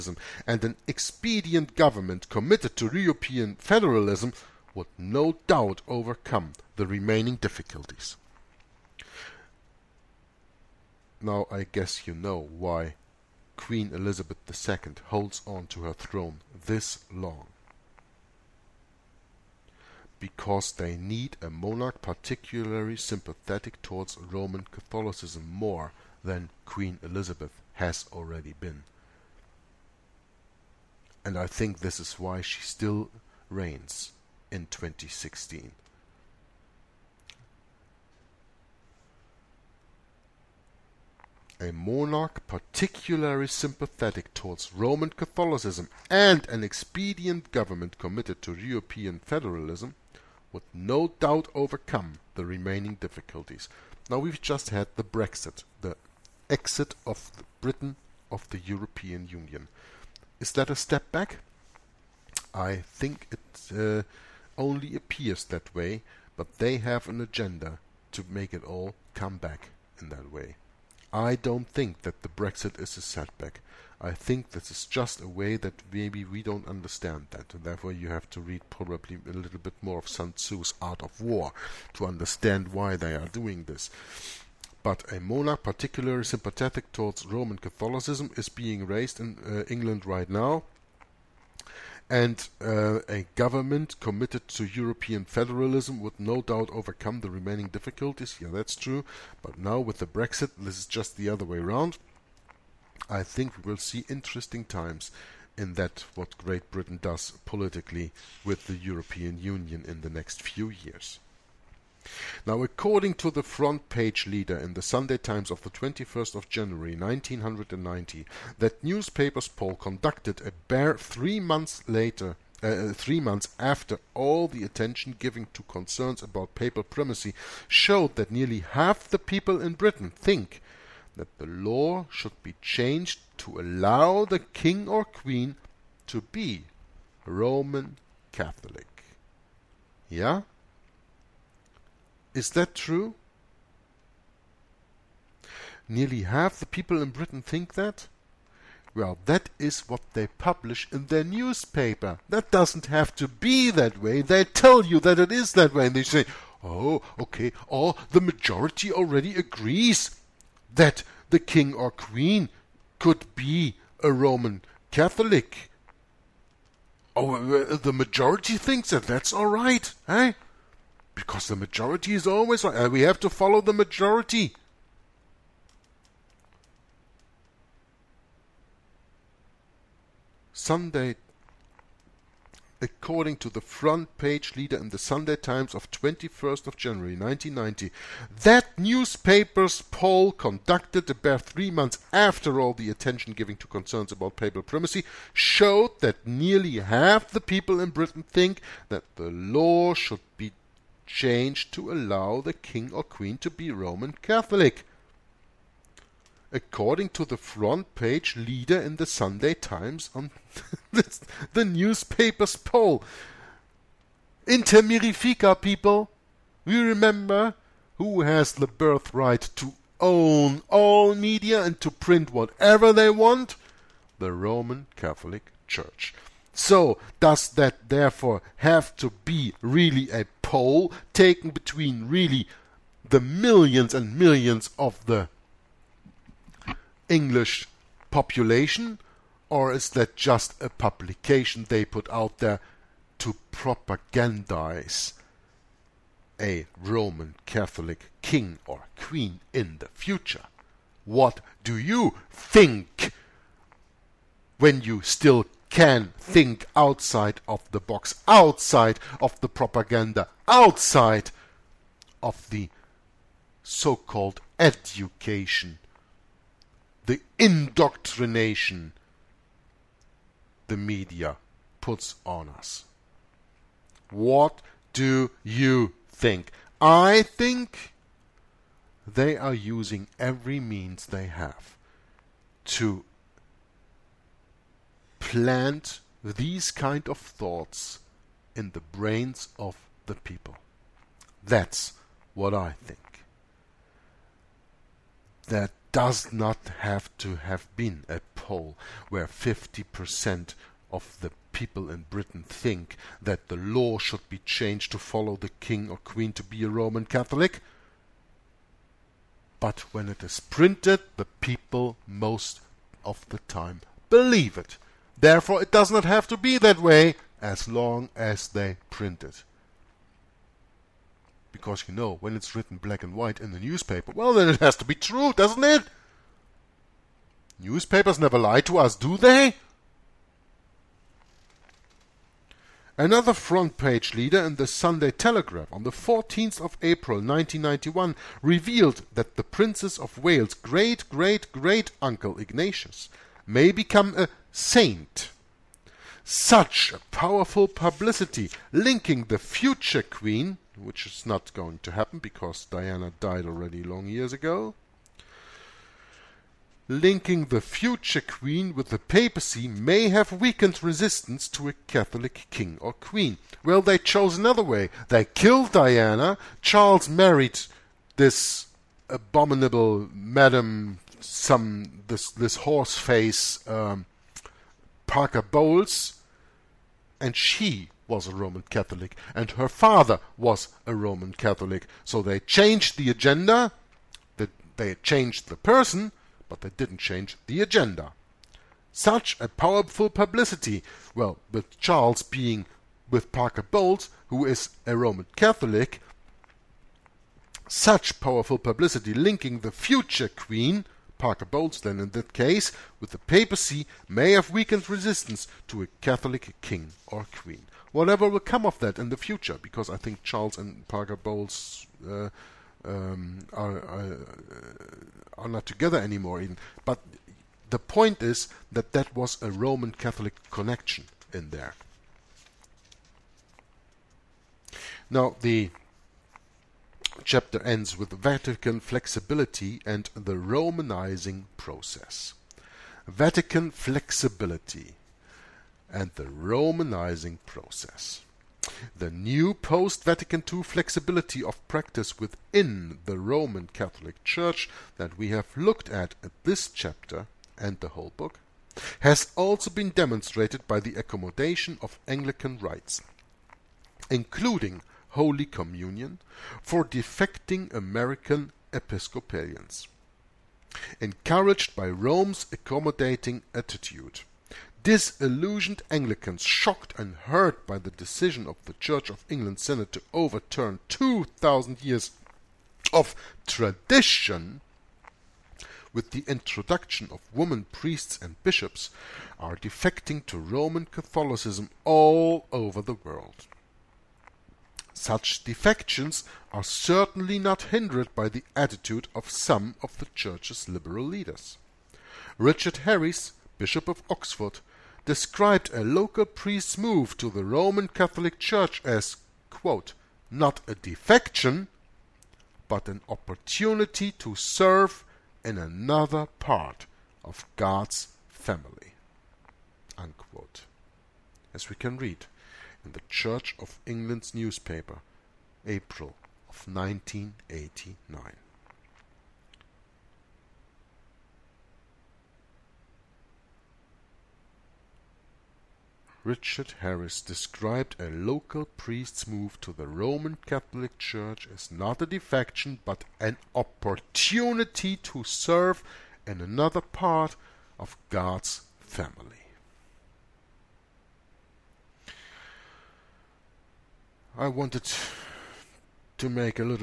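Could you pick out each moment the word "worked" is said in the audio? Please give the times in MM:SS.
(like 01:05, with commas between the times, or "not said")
not said.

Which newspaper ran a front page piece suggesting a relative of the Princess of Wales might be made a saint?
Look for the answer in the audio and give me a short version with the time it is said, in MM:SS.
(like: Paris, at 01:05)
Sunday Telegraph, at 05:34.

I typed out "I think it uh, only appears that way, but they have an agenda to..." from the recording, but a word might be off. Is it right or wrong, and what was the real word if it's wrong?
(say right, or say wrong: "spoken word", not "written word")
right.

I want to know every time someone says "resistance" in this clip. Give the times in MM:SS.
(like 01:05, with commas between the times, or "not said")
06:00, 06:44.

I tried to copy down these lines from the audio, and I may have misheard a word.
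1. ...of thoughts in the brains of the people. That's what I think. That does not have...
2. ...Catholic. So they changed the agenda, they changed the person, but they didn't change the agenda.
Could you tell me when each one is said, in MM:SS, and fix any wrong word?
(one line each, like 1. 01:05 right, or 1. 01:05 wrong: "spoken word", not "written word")
1. 04:47 right
2. 06:21 right.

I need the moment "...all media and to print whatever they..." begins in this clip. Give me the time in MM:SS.
03:40.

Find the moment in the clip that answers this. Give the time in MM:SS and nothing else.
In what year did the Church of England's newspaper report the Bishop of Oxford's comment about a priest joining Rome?
08:36.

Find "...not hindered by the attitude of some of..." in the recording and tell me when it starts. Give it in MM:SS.
08:07.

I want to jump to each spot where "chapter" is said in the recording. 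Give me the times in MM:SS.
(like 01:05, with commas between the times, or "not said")
07:07, 07:26.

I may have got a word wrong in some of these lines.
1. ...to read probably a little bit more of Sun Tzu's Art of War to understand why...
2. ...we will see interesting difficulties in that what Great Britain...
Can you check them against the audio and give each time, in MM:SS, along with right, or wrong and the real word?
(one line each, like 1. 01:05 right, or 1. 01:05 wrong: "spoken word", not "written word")
1. 01:18 right
2. 01:43 wrong: "times", not "difficulties".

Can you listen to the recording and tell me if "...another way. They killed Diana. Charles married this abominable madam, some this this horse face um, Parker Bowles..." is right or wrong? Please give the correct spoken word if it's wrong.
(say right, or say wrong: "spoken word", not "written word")
right.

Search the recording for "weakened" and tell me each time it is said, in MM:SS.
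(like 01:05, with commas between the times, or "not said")
06:00, 06:44.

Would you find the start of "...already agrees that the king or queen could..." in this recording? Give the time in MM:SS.
02:38.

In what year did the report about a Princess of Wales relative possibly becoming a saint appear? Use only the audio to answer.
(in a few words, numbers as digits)
1991.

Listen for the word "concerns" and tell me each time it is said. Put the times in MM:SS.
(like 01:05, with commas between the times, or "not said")
02:05, 03:13.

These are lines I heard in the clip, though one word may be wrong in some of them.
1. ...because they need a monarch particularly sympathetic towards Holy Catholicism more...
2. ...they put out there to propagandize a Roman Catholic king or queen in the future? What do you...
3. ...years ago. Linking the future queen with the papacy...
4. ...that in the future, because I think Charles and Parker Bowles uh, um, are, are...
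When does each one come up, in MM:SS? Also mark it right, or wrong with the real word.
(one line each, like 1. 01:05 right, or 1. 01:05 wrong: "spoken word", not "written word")
1. 00:20 wrong: "Roman", not "Holy"
2. 04:01 right
3. 05:54 right
4. 06:48 right.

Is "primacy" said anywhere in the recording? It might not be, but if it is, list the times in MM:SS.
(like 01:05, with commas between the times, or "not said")
02:06, 03:14.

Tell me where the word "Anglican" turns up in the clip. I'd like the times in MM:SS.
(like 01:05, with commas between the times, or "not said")
07:32, 07:45.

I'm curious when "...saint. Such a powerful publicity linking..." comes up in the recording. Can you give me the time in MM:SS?
05:44.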